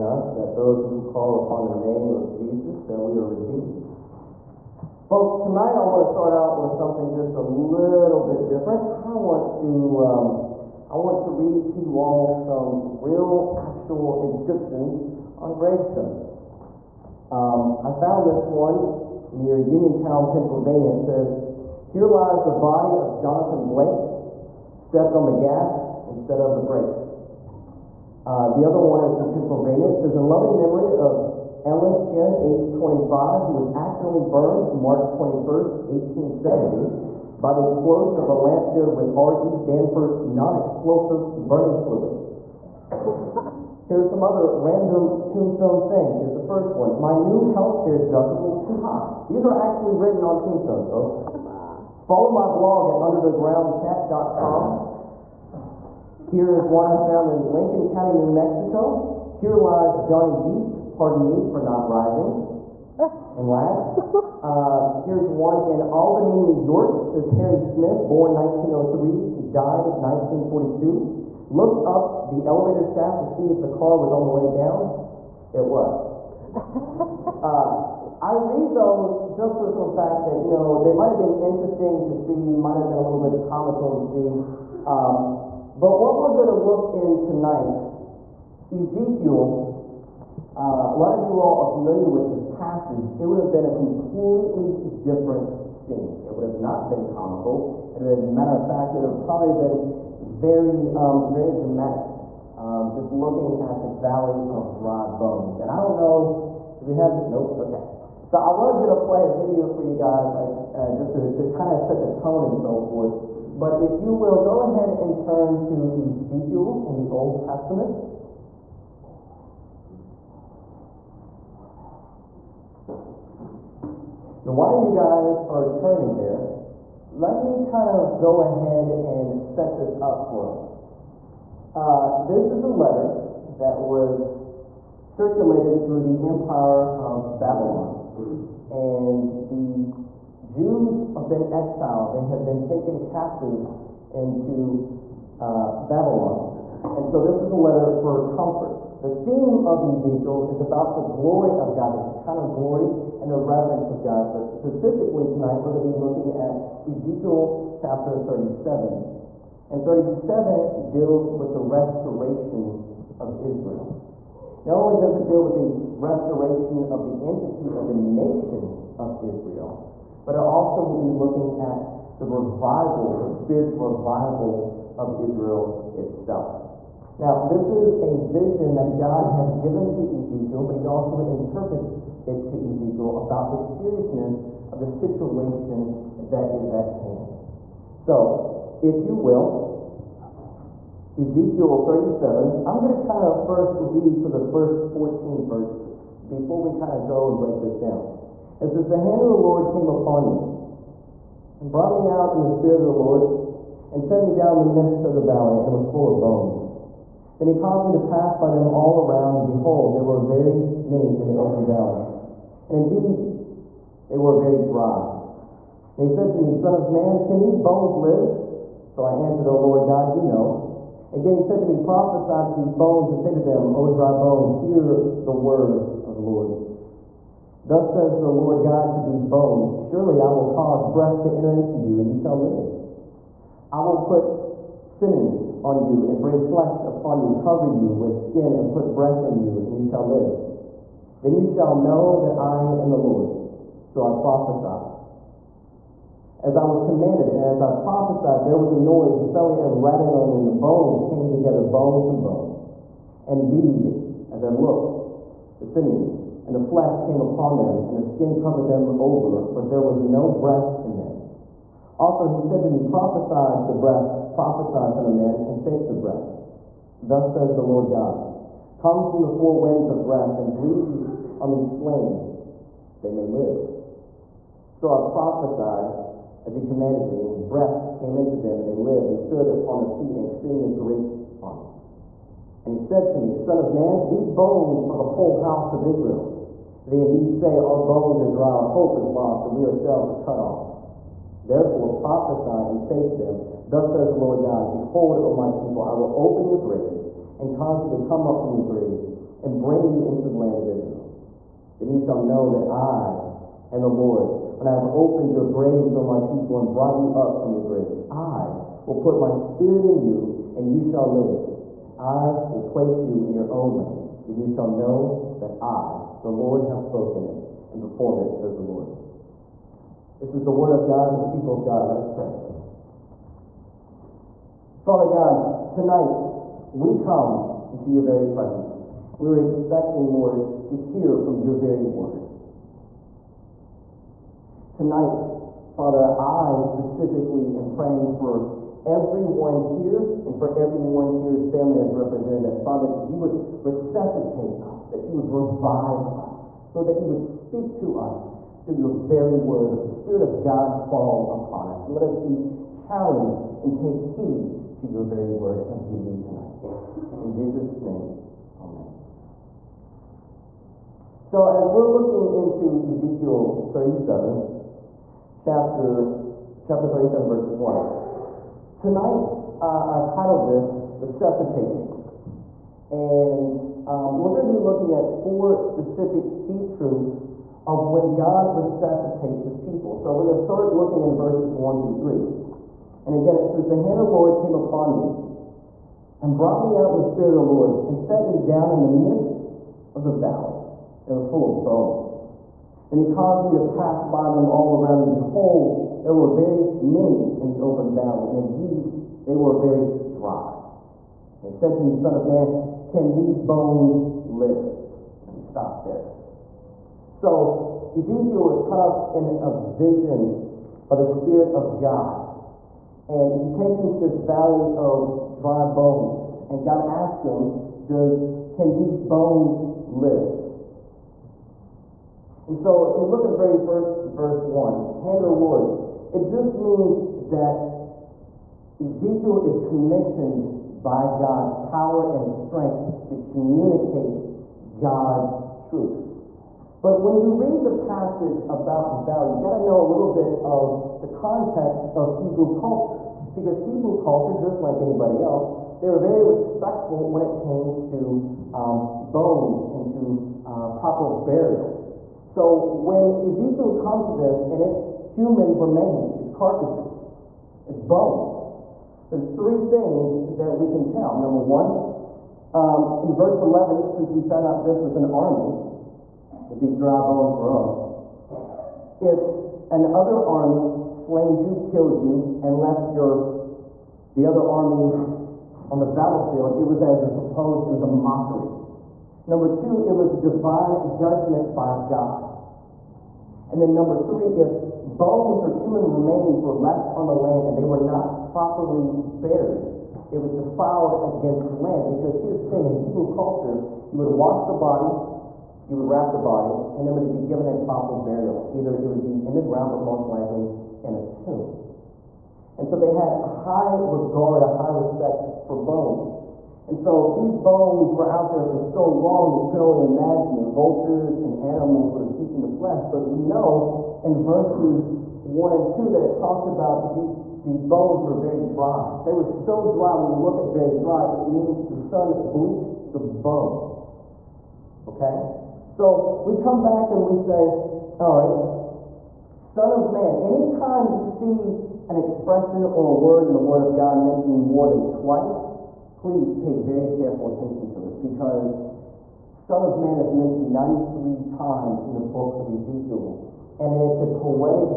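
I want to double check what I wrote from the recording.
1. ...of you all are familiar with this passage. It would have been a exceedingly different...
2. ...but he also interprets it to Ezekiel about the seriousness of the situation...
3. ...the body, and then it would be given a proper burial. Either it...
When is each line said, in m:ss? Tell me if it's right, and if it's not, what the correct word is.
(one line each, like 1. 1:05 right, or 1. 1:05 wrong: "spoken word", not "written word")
1. 1:31 wrong: "completely", not "exceedingly"
2. 3:00 right
3. 8:16 right.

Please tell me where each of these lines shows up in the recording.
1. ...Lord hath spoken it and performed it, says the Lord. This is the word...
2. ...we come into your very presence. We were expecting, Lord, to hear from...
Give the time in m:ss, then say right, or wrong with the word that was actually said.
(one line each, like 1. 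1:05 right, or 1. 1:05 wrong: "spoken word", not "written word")
1. 5:16 right
2. 5:26 right.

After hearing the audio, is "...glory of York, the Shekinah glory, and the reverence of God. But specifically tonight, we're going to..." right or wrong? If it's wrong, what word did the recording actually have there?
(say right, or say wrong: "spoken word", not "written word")
wrong: "God", not "York".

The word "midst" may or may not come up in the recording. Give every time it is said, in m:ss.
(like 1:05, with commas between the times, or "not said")
3:24, 6:29.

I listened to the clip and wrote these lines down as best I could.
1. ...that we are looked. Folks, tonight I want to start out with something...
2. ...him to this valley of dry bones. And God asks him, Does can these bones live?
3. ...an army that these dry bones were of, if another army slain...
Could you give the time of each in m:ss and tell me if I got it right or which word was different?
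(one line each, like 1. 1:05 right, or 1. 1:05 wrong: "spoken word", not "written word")
1. 0:02 wrong: "redeemed", not "looked"
2. 6:53 right
3. 7:44 right.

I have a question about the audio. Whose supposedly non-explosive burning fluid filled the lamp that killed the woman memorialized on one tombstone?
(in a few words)
R.E. Danforth.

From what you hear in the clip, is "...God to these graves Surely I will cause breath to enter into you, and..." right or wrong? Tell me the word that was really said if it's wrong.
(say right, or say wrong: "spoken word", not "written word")
wrong: "bones", not "graves".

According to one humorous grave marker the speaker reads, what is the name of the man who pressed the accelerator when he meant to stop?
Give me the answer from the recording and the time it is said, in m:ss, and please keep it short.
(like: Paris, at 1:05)
Jonathan Blake, at 0:23.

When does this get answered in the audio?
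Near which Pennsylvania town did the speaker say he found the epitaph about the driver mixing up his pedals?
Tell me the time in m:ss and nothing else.
0:19.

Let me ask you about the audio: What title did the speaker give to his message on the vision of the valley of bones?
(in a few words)
Resuscitate Me.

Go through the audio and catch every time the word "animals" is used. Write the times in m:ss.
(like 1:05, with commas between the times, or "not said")
8:31.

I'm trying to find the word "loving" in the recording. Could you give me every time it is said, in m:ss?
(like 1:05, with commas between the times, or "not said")
0:30.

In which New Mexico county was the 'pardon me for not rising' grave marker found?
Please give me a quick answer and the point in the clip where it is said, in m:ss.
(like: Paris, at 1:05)
Lincoln County, at 0:57.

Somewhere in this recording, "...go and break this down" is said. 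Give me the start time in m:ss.
3:17.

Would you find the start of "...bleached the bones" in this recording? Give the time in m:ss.
8:42.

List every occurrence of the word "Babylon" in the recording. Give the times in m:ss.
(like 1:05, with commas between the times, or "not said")
2:17, 2:25.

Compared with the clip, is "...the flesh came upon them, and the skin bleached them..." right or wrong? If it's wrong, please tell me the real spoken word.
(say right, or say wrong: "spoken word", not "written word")
wrong: "covered", not "bleached".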